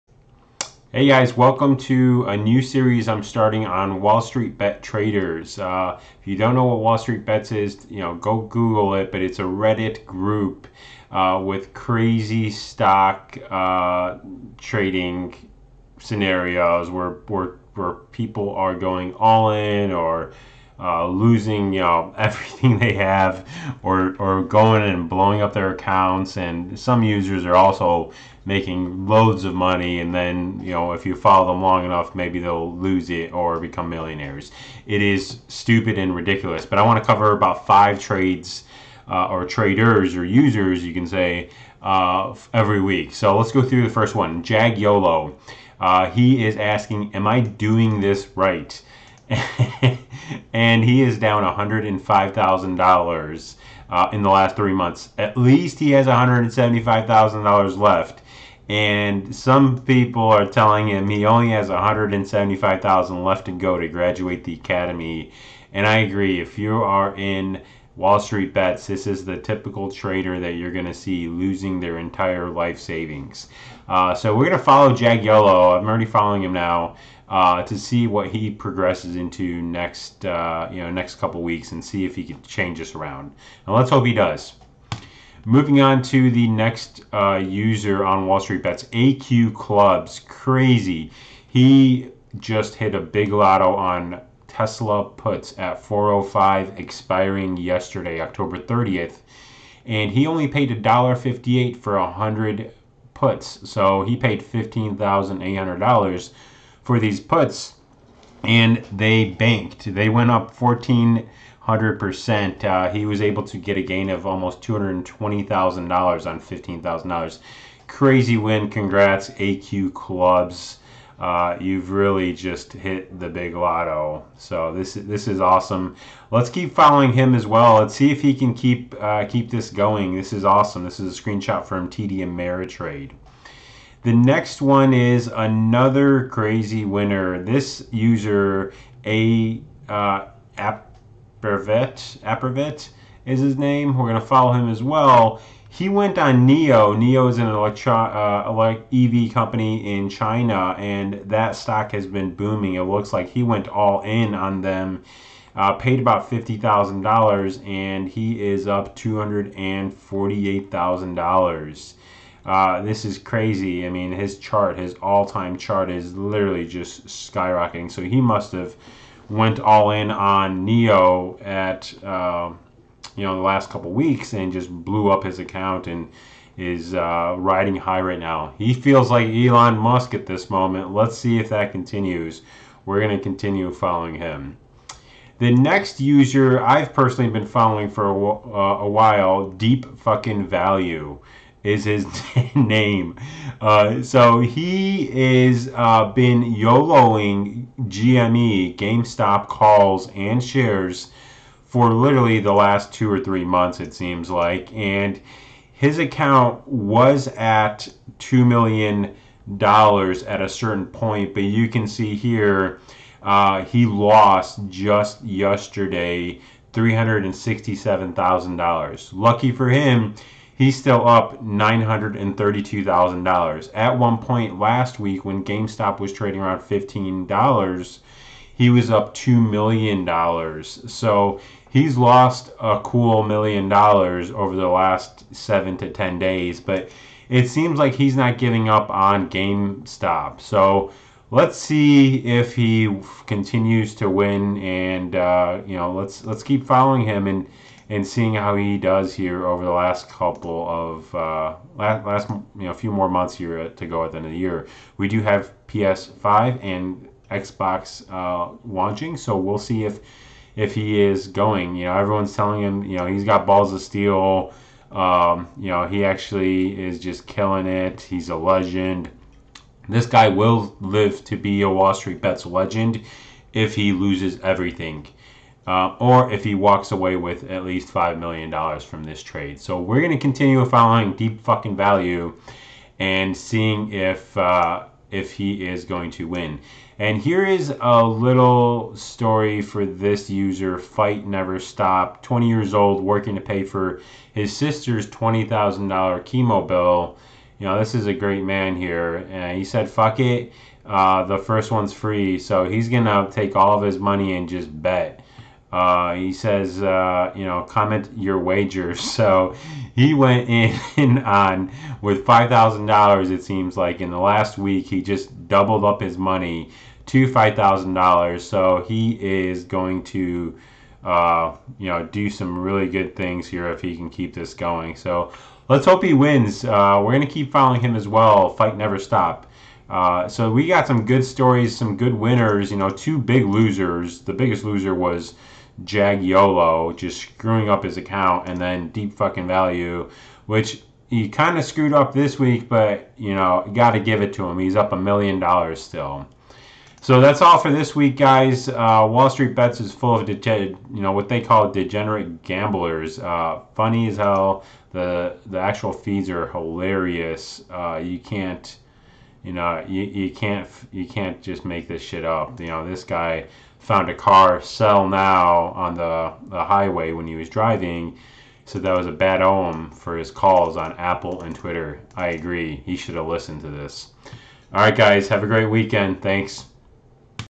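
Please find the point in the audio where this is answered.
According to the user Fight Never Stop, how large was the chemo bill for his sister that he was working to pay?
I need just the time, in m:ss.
4:55.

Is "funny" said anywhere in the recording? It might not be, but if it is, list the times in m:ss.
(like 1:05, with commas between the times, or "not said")
5:53.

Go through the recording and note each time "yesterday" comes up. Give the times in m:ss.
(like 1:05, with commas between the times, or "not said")
1:37, 3:35.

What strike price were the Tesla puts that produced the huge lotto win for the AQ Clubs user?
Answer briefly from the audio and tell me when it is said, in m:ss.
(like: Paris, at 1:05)
405, at 1:35.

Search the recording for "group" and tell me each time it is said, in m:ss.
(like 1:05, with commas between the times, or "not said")
0:10.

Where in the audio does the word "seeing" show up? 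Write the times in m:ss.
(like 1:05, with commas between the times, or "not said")
4:08, 4:43.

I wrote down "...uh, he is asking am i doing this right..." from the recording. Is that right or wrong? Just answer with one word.
right.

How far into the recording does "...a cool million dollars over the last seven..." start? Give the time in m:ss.
3:52.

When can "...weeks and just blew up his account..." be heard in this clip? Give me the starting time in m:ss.
2:53.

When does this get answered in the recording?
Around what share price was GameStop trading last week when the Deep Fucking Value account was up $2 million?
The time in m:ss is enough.
3:46.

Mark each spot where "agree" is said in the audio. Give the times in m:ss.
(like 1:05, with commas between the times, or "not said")
1:05, 6:12.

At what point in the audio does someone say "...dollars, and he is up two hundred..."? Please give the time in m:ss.
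2:37.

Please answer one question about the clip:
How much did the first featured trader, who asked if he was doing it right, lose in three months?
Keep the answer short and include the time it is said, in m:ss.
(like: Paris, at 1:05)
$105,000, at 0:51.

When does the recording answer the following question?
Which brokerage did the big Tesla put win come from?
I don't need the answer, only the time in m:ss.
2:11.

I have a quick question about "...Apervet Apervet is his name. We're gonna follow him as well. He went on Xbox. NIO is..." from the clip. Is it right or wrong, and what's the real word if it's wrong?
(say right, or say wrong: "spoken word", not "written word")
wrong: "NIO", not "Xbox".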